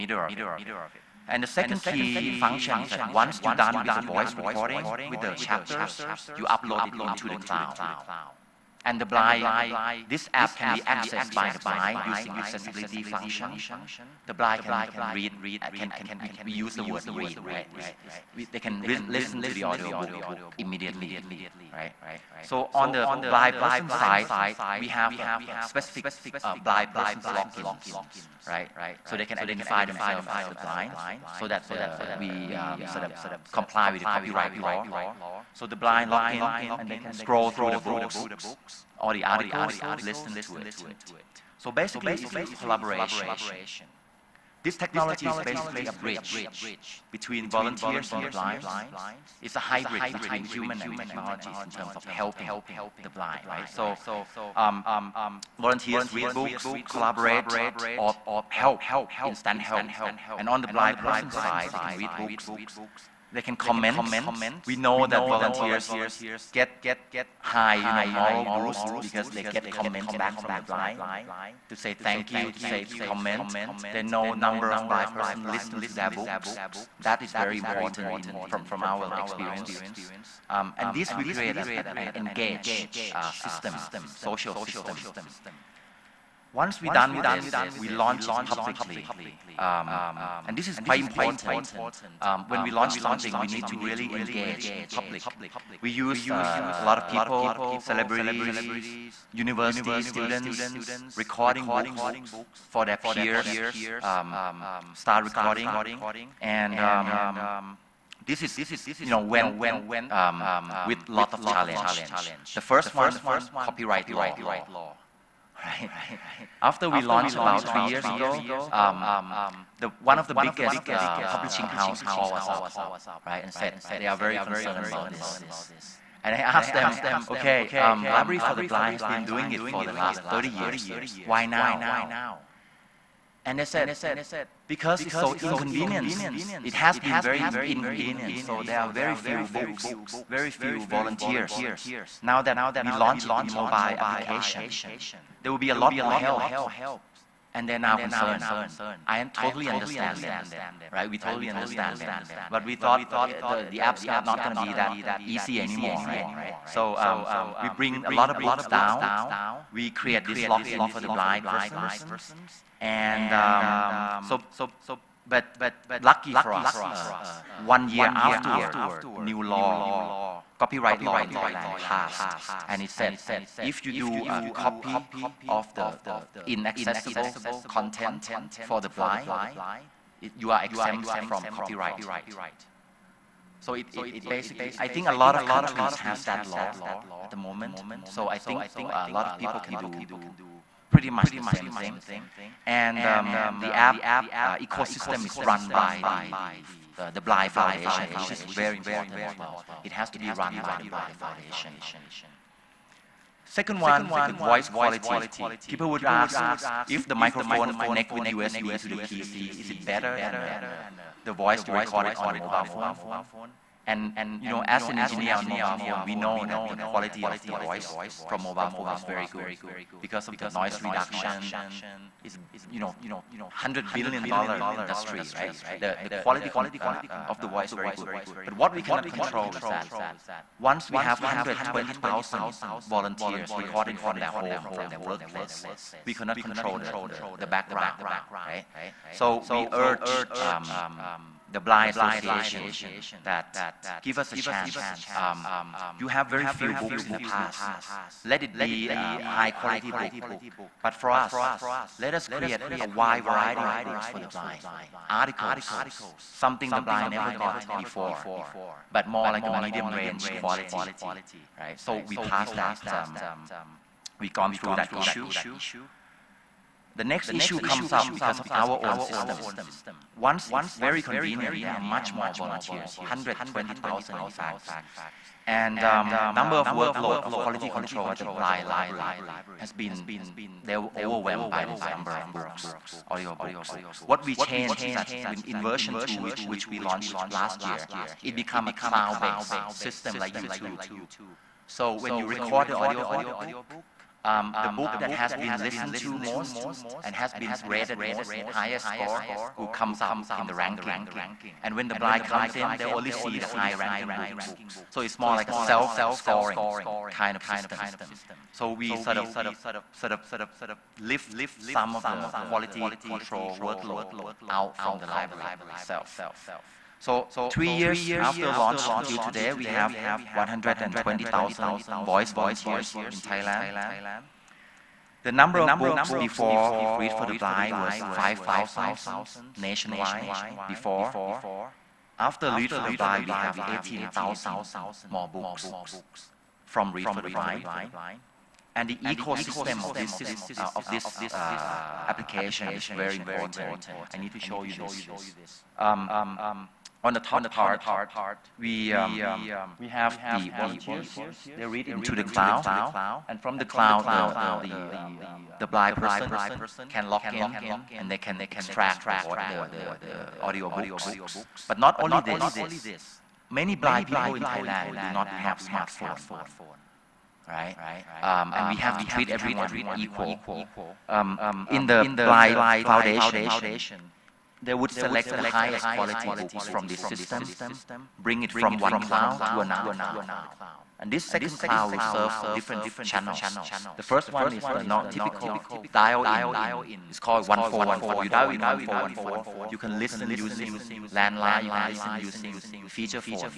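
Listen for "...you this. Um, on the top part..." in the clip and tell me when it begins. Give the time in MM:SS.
05:44.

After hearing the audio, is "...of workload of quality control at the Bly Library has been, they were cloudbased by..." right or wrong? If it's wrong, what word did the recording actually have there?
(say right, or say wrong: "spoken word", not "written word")
wrong: "overwhelmed", not "cloudbased".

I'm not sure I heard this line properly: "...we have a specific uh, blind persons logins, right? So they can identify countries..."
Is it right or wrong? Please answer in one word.
wrong.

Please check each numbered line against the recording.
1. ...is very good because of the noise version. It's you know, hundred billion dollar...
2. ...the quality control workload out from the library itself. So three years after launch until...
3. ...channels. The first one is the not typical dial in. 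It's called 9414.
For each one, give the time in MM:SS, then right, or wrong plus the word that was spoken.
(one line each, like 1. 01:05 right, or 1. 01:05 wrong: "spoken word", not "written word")
1. 03:38 wrong: "reduction", not "version"
2. 05:12 right
3. 06:23 wrong: "1414", not "9414".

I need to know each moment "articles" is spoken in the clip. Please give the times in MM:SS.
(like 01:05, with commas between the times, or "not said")
00:39, 04:15.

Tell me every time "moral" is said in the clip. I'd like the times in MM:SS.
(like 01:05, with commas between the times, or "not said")
01:08.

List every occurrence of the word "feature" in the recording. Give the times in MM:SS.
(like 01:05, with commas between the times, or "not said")
06:32.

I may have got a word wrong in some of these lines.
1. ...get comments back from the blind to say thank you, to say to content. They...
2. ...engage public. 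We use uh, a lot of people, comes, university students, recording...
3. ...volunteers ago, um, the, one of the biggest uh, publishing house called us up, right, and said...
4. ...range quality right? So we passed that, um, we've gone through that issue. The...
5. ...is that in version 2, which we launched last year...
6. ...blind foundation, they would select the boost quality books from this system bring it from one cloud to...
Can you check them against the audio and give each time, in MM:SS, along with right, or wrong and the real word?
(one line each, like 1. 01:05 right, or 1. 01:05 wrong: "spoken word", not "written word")
1. 01:09 wrong: "comment", not "content"
2. 01:34 wrong: "celebrities", not "comes"
3. 01:57 wrong: "years", not "volunteers"
4. 04:19 right
5. 04:44 right
6. 06:12 wrong: "highest", not "boost".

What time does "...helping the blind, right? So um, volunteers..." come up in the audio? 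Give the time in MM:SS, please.
00:52.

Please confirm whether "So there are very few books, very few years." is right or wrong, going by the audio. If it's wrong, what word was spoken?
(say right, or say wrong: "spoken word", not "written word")
wrong: "volunteers", not "years".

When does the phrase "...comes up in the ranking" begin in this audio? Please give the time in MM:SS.
04:59.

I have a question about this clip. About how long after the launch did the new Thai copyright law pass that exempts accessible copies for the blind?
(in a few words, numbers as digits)
1 year.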